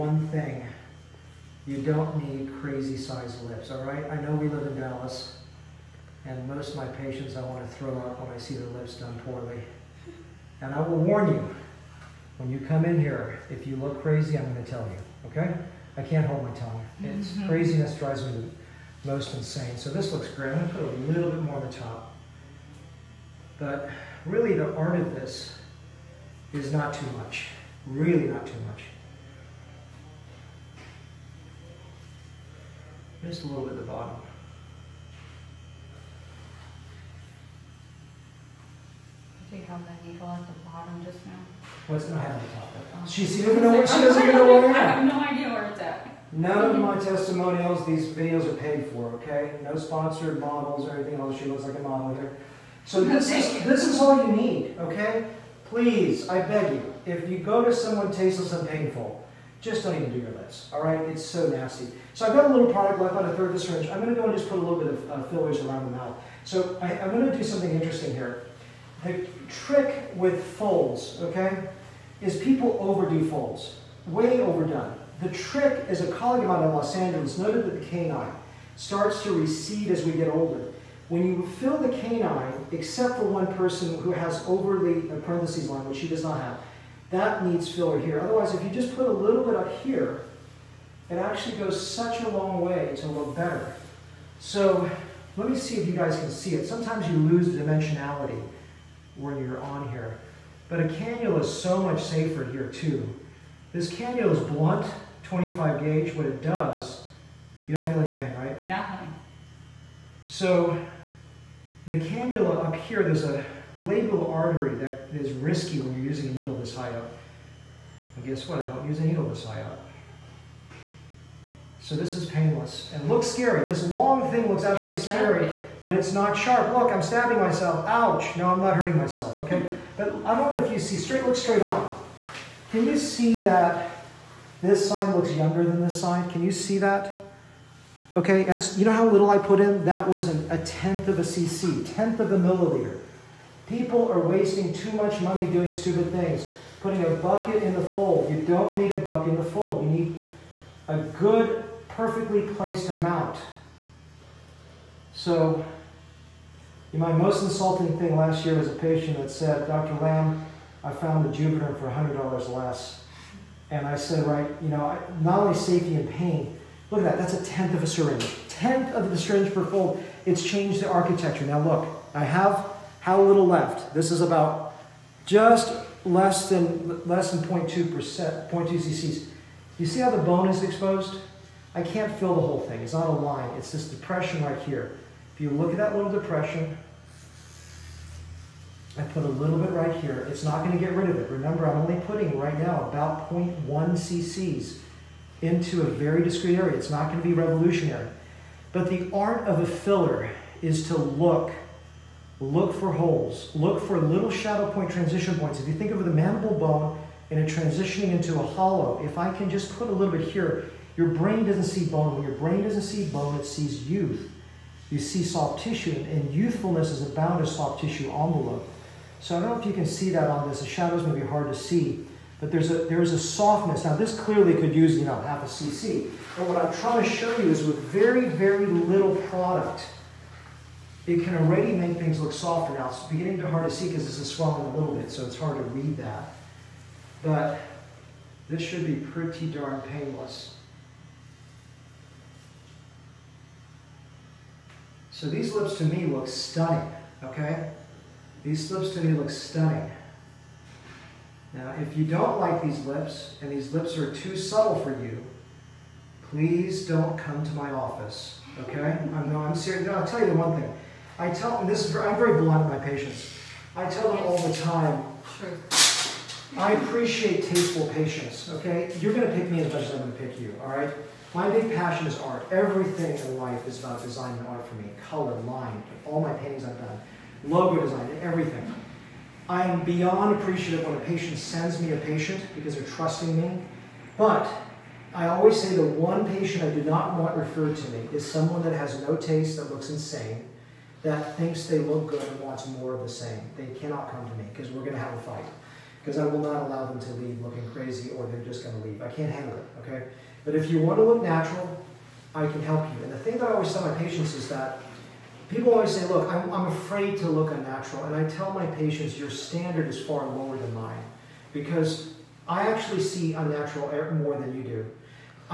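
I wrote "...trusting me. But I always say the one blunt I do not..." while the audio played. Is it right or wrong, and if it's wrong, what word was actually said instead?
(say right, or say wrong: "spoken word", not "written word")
wrong: "patient", not "blunt".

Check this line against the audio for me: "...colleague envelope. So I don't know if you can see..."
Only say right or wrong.
wrong.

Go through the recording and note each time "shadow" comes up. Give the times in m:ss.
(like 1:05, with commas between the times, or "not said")
3:24, 3:40.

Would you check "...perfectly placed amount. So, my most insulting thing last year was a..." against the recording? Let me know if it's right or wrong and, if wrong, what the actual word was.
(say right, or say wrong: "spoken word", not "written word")
right.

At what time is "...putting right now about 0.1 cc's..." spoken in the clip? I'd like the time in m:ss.
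3:12.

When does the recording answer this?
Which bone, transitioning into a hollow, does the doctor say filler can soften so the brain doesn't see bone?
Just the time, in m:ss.
3:26.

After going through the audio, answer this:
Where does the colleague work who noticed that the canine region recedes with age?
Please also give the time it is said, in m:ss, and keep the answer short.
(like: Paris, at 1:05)
Los Angeles, at 1:16.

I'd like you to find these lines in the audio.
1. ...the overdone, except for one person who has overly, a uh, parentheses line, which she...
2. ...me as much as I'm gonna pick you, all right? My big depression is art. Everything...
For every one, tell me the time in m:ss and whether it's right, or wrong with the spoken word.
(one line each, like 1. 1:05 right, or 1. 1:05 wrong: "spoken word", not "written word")
1. 1:21 wrong: "canine", not "overdone"
2. 4:29 wrong: "passion", not "depression".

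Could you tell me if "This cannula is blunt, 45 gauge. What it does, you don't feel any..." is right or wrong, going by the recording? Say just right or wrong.
wrong.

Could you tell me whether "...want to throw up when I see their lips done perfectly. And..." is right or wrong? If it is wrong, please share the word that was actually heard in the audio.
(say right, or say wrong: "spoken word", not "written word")
wrong: "poorly", not "perfectly".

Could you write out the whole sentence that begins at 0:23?
But really the art of this is not too much.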